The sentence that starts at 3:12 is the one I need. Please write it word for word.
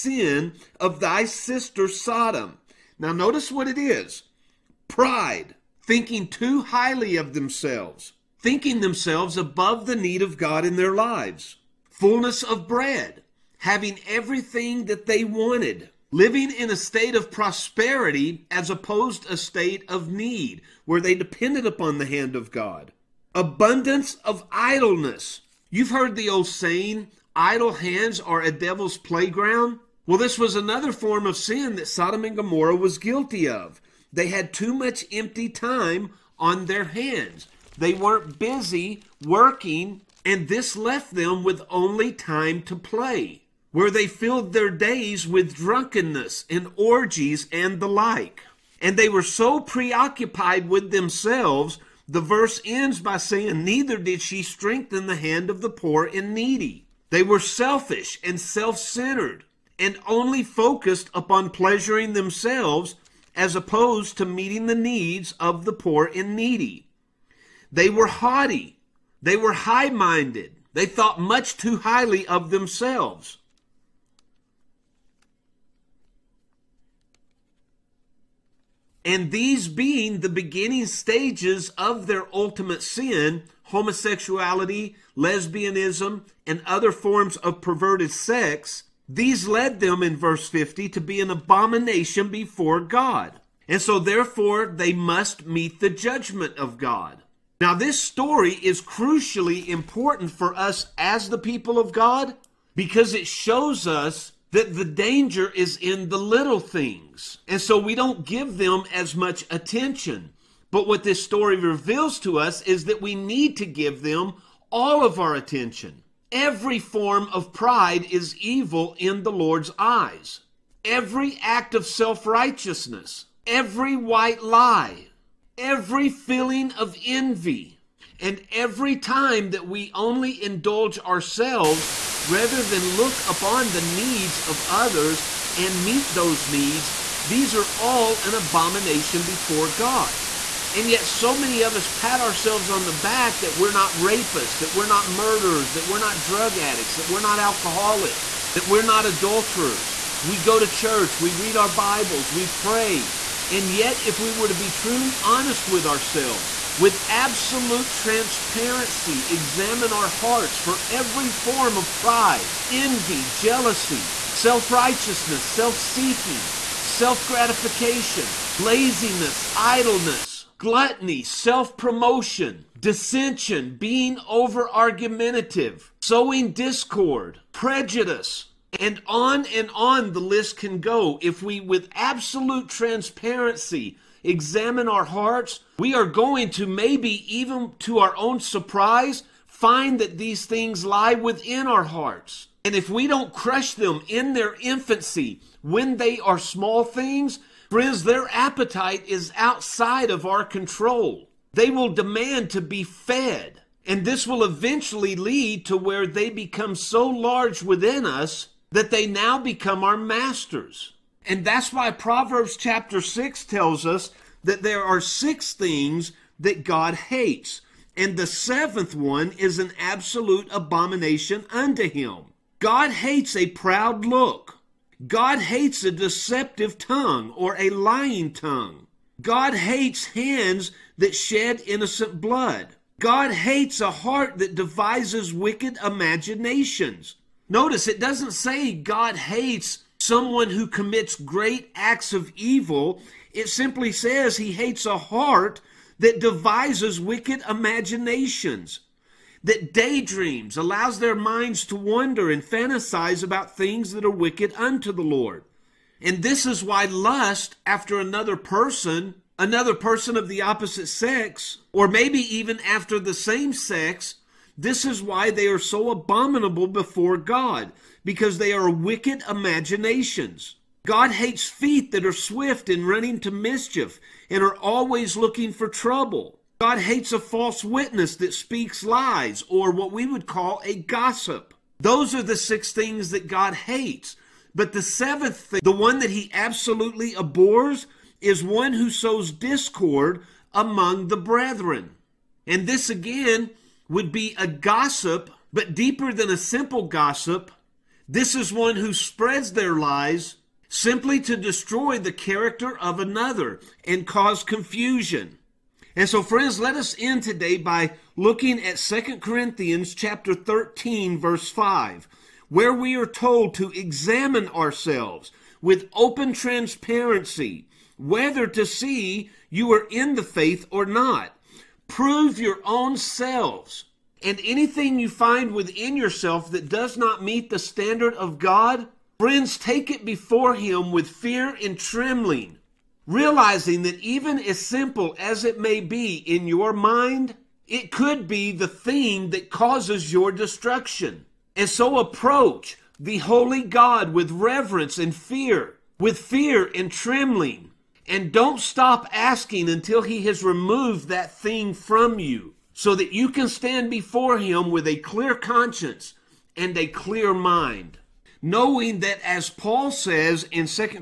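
And if we don't crush them in their infancy, when they are small things, friends, their appetite is outside of our control.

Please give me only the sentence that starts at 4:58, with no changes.
This is one who spreads their lies simply to destroy the character of another and cause confusion.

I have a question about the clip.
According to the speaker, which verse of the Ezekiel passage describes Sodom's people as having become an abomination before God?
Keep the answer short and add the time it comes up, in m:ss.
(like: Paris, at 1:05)
Verse 50, at 1:30.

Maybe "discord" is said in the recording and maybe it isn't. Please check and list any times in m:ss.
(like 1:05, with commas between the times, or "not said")
2:56, 4:49.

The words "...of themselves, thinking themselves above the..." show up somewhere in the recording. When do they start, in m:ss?
0:07.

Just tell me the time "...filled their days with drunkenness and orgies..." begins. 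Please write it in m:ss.
0:44.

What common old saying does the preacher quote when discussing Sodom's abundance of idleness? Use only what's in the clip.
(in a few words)
Idle hands are a devil's playground.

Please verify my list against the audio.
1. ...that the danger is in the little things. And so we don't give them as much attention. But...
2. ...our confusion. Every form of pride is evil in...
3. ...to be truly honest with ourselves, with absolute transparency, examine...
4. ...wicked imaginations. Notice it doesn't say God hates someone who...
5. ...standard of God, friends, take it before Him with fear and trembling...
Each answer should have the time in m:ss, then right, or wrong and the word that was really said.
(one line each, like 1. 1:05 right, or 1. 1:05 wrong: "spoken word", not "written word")
1. 1:44 right
2. 1:55 wrong: "attention", not "confusion"
3. 2:34 right
4. 3:55 right
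5. 5:27 right.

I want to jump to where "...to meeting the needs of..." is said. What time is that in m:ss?
1:04.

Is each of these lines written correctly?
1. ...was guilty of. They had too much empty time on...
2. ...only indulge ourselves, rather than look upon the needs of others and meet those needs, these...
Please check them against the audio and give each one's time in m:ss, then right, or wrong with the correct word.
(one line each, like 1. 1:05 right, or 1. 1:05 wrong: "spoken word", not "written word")
1. 0:32 right
2. 2:09 right.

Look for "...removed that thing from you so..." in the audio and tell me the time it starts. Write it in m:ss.
5:50.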